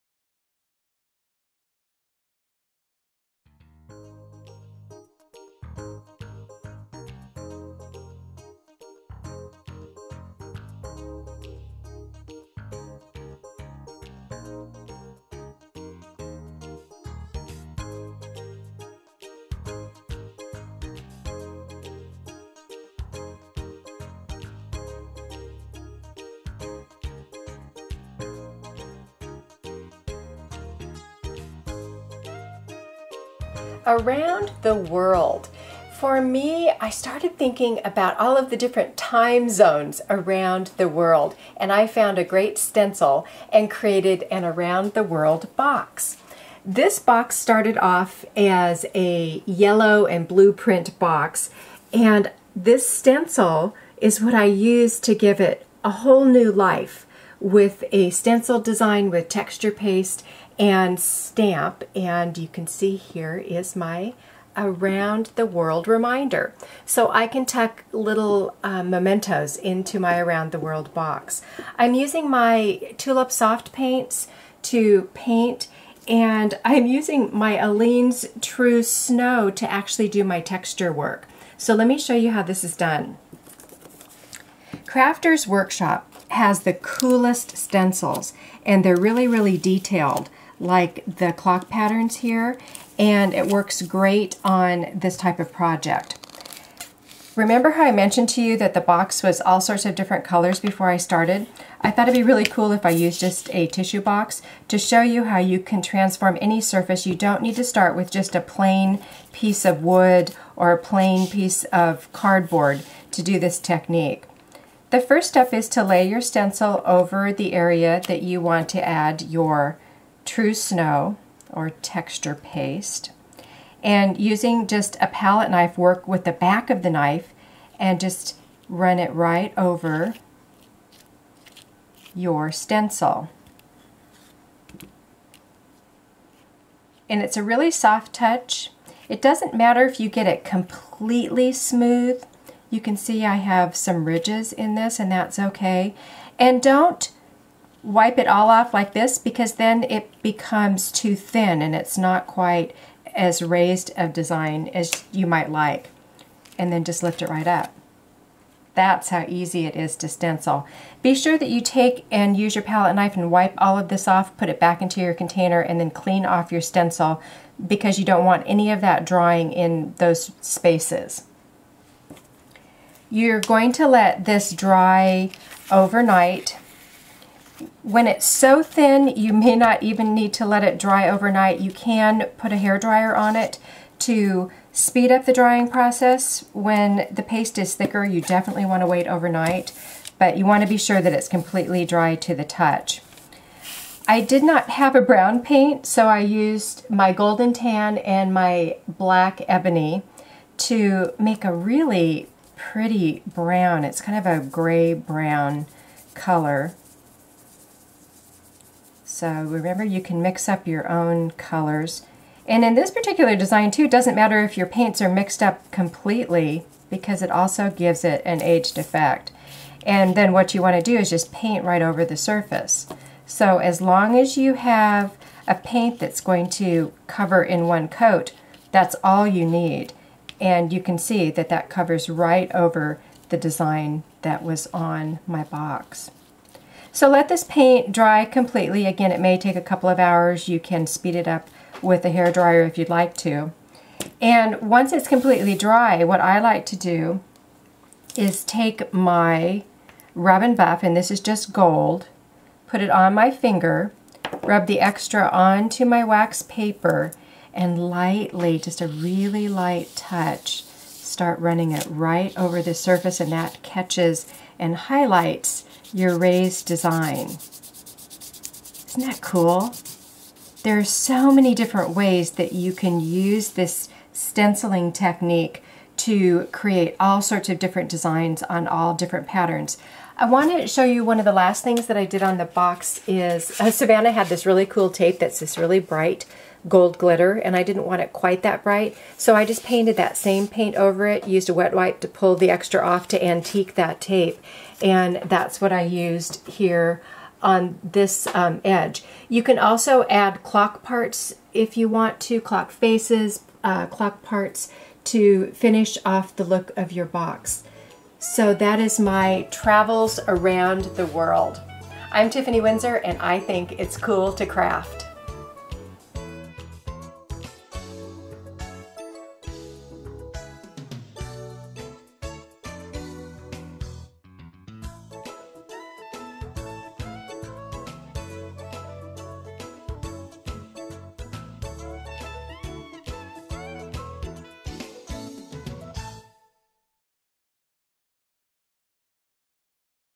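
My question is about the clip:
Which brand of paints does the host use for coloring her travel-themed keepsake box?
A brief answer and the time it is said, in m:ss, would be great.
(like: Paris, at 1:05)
Tulip Soft Paints, at 1:12.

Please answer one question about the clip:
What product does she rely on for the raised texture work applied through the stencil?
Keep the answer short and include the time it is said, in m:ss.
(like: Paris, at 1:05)
Aleene's True Snow, at 1:17.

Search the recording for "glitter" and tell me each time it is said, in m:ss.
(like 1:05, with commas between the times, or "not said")
4:46.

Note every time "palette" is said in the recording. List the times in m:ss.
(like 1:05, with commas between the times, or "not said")
2:05, 2:42.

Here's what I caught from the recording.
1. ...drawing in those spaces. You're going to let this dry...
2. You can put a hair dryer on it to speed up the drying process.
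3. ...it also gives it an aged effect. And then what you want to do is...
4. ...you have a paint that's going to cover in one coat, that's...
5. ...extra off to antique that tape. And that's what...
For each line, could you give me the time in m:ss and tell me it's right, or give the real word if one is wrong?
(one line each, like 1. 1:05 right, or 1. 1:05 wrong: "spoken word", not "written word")
1. 2:49 right
2. 3:01 right
3. 3:37 right
4. 3:44 right
5. 4:52 right.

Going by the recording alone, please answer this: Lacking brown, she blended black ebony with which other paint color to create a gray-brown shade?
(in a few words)
golden tan.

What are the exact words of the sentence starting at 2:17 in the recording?
And it's a really soft touch.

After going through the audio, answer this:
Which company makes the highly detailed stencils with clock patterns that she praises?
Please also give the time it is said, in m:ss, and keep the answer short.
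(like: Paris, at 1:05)
Crafter's Workshop, at 1:24.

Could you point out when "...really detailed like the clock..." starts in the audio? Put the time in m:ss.
1:29.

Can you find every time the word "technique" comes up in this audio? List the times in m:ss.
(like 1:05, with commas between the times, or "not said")
1:53, 4:34.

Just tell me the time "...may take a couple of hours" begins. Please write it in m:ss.
3:59.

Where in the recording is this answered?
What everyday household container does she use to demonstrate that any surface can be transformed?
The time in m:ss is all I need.
1:43.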